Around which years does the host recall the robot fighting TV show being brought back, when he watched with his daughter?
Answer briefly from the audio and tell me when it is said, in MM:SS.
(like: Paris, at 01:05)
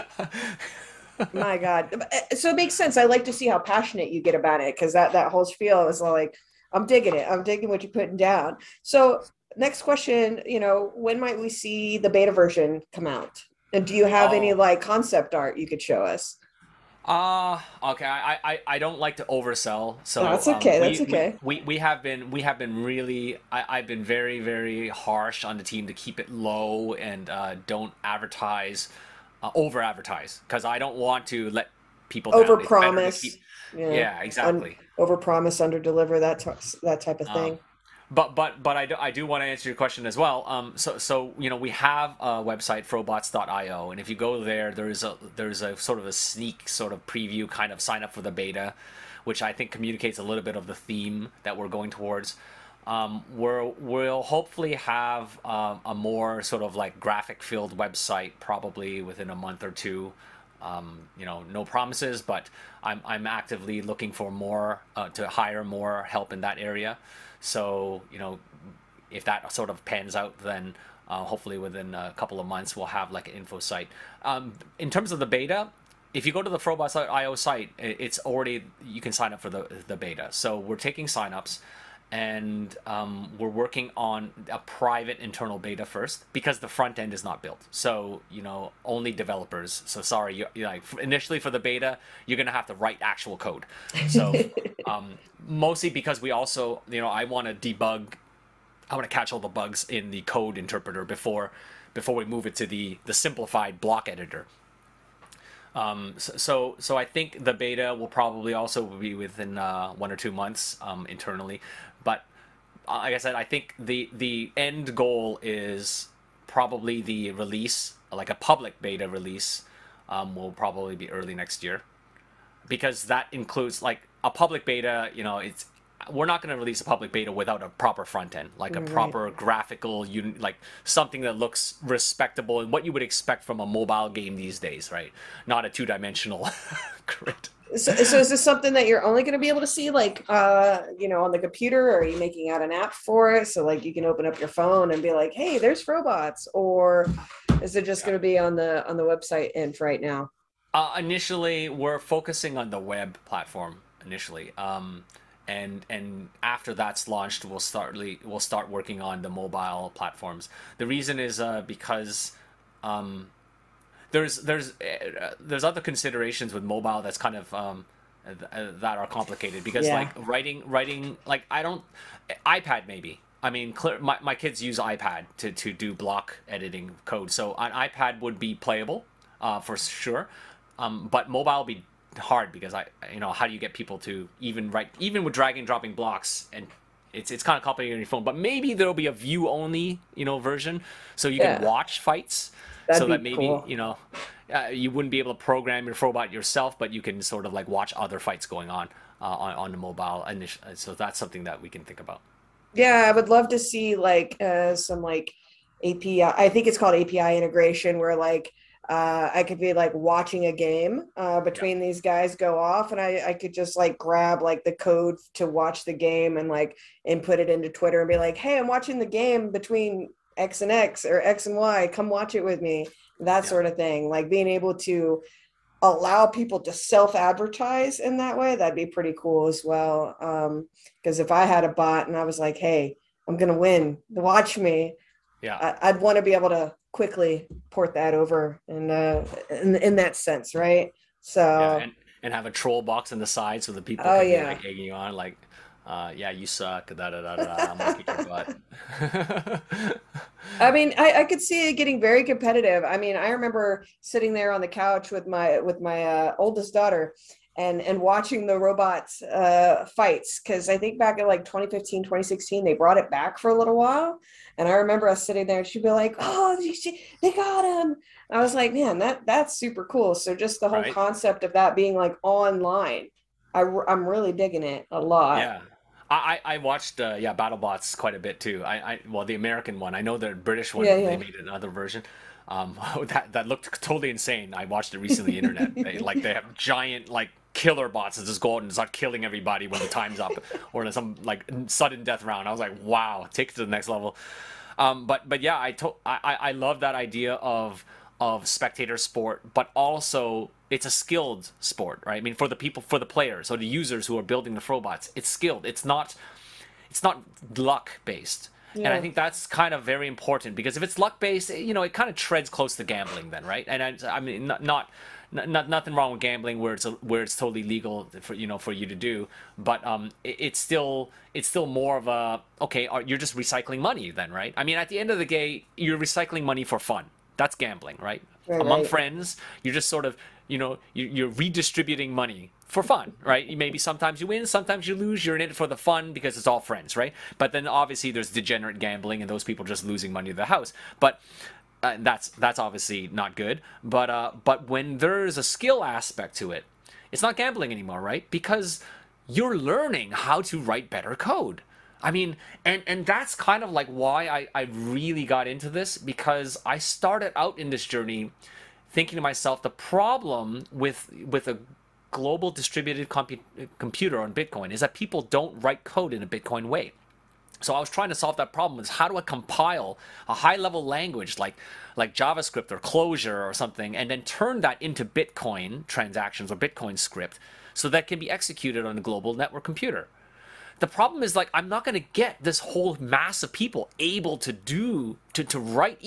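2015 2016, at 04:21.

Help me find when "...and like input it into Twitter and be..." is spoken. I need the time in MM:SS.
03:36.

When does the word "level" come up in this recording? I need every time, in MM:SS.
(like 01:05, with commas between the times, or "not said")
04:53, 06:10.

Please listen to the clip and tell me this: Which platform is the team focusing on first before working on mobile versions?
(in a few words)
web platform.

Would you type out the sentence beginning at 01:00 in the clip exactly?
Um, you know, no promises, but I'm, I'm actively looking for more uh, to hire more help in that area.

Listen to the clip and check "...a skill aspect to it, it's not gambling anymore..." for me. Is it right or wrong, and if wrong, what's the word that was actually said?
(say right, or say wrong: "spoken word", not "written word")
right.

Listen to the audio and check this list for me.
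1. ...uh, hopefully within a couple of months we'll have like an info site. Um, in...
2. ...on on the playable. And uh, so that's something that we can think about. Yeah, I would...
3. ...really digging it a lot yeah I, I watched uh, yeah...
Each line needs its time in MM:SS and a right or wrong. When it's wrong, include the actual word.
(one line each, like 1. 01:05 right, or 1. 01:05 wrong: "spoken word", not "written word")
1. 01:11 right
2. 03:19 wrong: "mobile", not "playable"
3. 04:34 right.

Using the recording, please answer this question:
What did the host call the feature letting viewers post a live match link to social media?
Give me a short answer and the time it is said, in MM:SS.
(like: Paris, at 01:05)
API integration, at 03:26.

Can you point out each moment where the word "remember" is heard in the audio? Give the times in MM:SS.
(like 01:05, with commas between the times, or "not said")
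04:13, 04:24.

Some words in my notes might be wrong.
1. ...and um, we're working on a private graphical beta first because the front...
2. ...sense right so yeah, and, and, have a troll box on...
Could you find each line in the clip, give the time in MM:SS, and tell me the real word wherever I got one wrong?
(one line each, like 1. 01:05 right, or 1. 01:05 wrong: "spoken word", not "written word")
1. 01:22 wrong: "internal", not "graphical"
2. 04:00 right.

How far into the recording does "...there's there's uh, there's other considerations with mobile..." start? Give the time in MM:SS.
02:44.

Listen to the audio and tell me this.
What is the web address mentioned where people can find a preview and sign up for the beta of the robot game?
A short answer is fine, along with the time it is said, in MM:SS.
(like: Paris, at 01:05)
frobots.io, at 00:42.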